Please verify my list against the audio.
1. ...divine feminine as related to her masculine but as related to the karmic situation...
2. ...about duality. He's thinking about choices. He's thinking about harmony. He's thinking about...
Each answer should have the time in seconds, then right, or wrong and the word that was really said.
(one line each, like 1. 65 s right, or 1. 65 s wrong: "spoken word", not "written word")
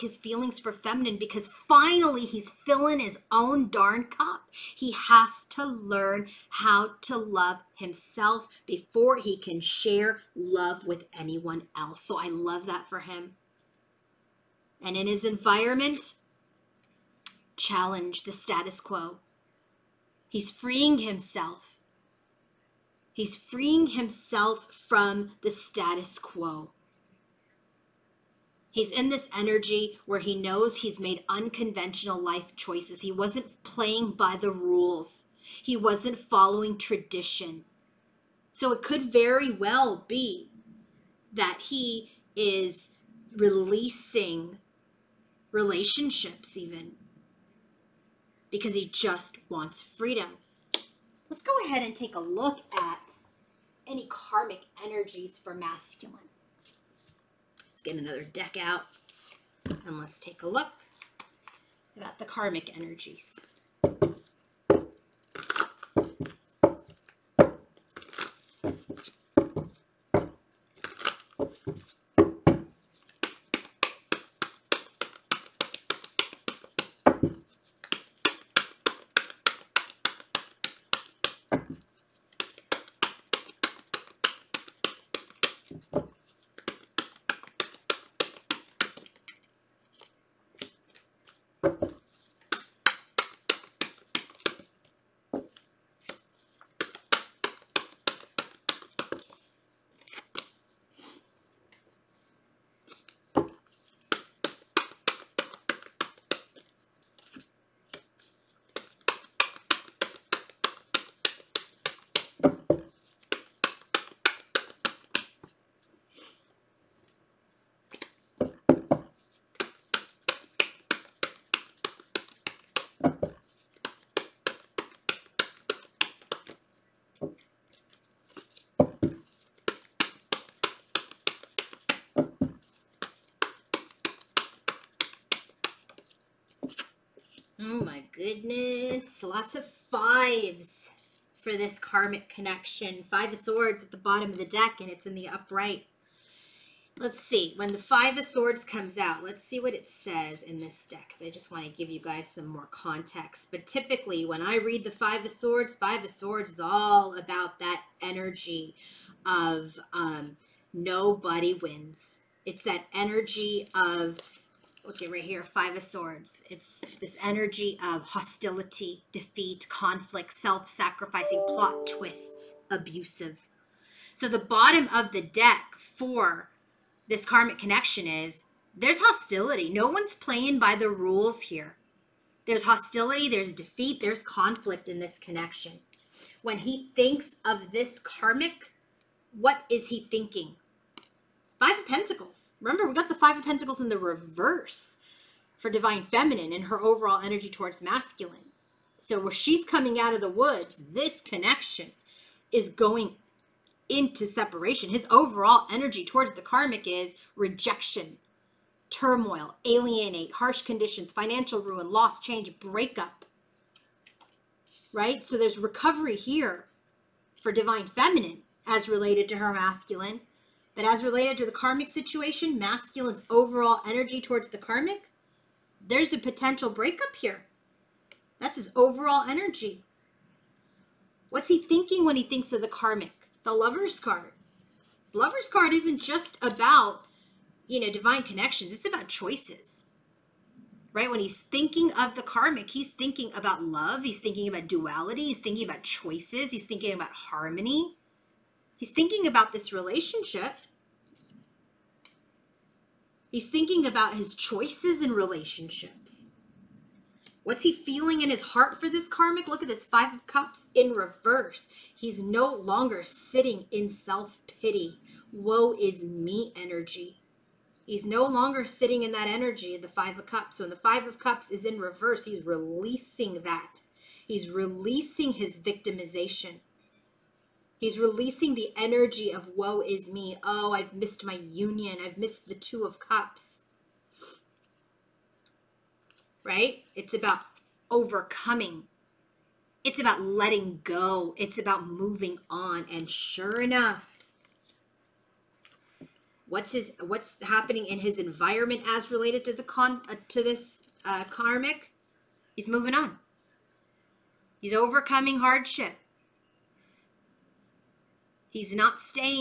1. 217 s right
2. 244 s right.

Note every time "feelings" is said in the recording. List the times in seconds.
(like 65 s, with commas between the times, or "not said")
0 s, 257 s.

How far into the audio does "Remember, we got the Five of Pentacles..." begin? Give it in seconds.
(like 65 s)
192 s.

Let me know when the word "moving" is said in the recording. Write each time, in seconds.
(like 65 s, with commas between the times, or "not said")
291 s, 302 s.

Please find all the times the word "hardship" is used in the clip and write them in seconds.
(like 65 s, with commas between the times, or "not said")
305 s.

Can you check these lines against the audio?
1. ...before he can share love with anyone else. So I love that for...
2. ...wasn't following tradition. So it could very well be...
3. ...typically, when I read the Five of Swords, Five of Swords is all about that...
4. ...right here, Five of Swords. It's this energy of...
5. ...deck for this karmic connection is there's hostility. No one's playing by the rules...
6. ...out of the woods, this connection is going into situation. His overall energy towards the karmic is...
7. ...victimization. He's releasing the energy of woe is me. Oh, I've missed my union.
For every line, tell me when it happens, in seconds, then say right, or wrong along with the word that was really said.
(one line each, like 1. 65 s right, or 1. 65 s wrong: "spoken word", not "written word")
1. 8 s right
2. 35 s right
3. 153 s right
4. 165 s right
5. 175 s right
6. 200 s wrong: "separation", not "situation"
7. 275 s right.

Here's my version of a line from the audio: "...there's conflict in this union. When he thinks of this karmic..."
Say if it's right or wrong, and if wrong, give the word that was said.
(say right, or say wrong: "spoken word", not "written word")
wrong: "connection", not "union".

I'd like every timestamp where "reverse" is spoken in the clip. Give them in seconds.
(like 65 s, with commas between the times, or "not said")
193 s, 260 s, 271 s.